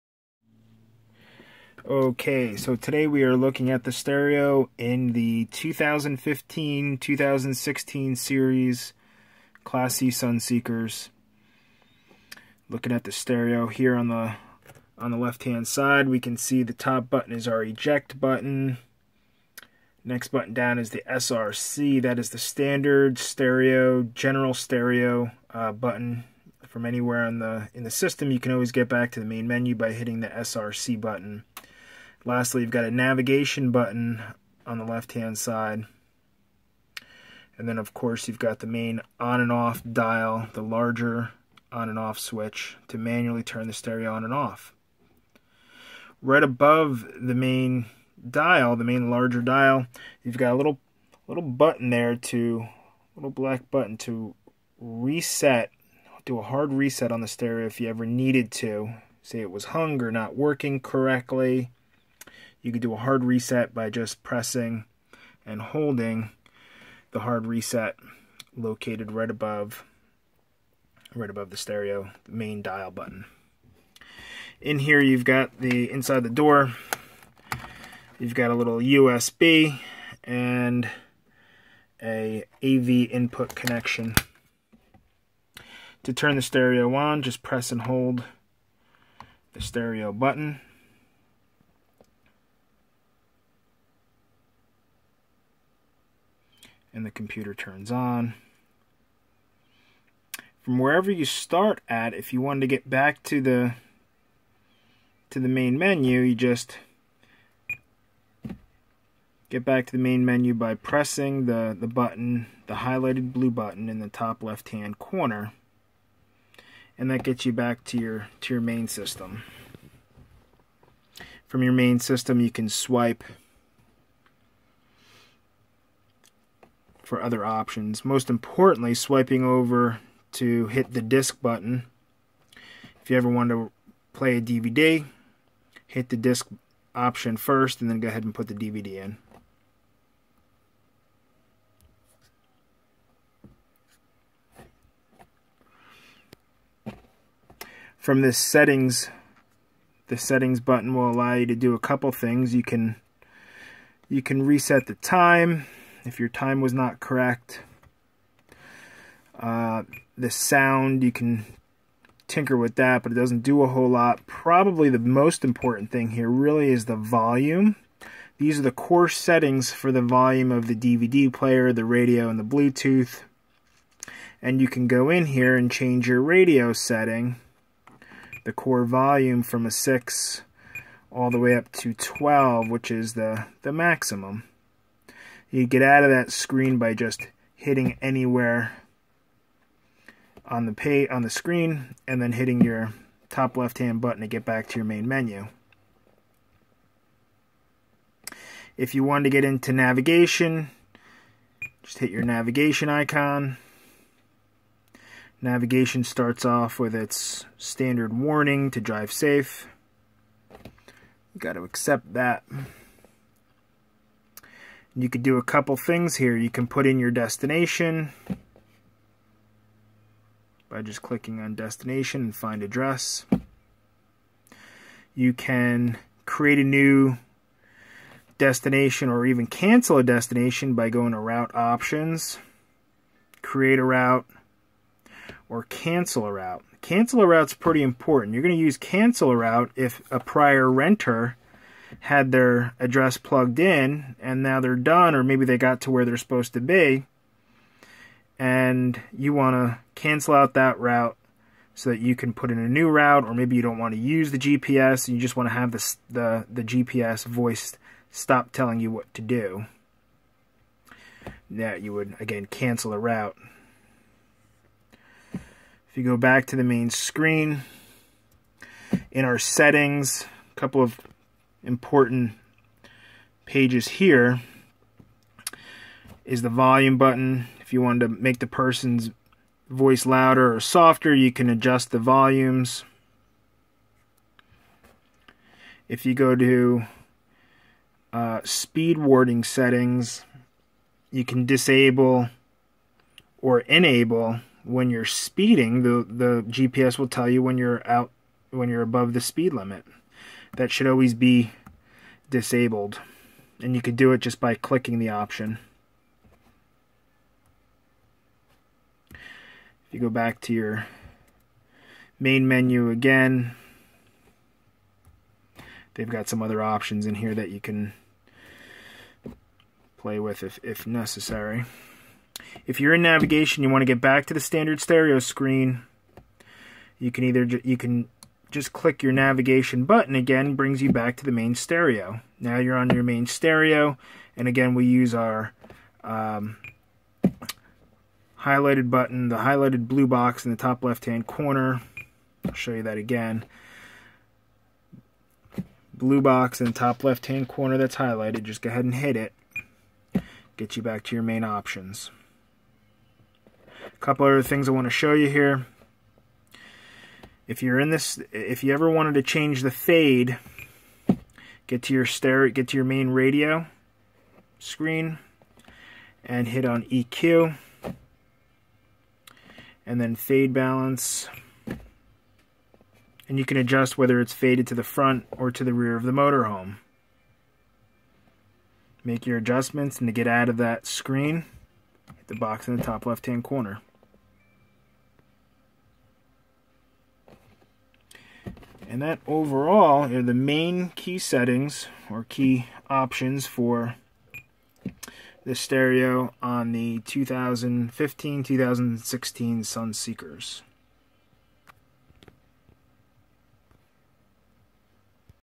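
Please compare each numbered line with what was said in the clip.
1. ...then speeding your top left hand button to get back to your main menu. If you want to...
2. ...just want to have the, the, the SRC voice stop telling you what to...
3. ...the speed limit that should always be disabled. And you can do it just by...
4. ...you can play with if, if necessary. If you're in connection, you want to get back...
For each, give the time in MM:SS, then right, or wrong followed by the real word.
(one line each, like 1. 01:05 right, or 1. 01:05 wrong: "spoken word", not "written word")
1. 03:12 wrong: "hitting", not "speeding"
2. 04:15 wrong: "GPS", not "SRC"
3. 04:59 right
4. 05:17 wrong: "navigation", not "connection".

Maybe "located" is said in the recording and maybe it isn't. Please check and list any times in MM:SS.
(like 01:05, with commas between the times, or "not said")
01:08.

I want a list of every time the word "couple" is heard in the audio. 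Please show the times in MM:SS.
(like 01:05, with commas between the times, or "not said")
02:31, 03:35, 04:30, 05:54.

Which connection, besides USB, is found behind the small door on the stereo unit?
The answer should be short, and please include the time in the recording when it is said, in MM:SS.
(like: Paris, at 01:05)
AV input, at 01:22.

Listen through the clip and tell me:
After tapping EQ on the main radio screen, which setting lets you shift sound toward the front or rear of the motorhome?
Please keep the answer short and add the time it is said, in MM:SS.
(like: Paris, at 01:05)
fade balance, at 06:10.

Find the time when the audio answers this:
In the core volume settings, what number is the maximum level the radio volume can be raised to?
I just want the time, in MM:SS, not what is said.
03:01.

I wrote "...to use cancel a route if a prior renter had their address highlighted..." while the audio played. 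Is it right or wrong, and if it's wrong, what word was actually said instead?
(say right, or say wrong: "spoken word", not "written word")
wrong: "plugged", not "highlighted".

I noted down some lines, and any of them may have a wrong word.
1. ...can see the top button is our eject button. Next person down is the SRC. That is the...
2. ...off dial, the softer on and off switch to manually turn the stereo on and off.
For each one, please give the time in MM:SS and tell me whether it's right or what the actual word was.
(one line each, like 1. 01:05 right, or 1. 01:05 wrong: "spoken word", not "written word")
1. 00:16 wrong: "button", not "person"
2. 00:39 wrong: "larger", not "softer".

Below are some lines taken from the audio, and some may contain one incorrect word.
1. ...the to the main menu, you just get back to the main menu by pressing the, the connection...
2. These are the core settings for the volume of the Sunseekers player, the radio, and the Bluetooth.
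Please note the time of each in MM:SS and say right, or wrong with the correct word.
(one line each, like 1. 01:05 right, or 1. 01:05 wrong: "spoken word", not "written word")
1. 01:43 wrong: "button", not "connection"
2. 02:48 wrong: "DVD", not "Sunseekers".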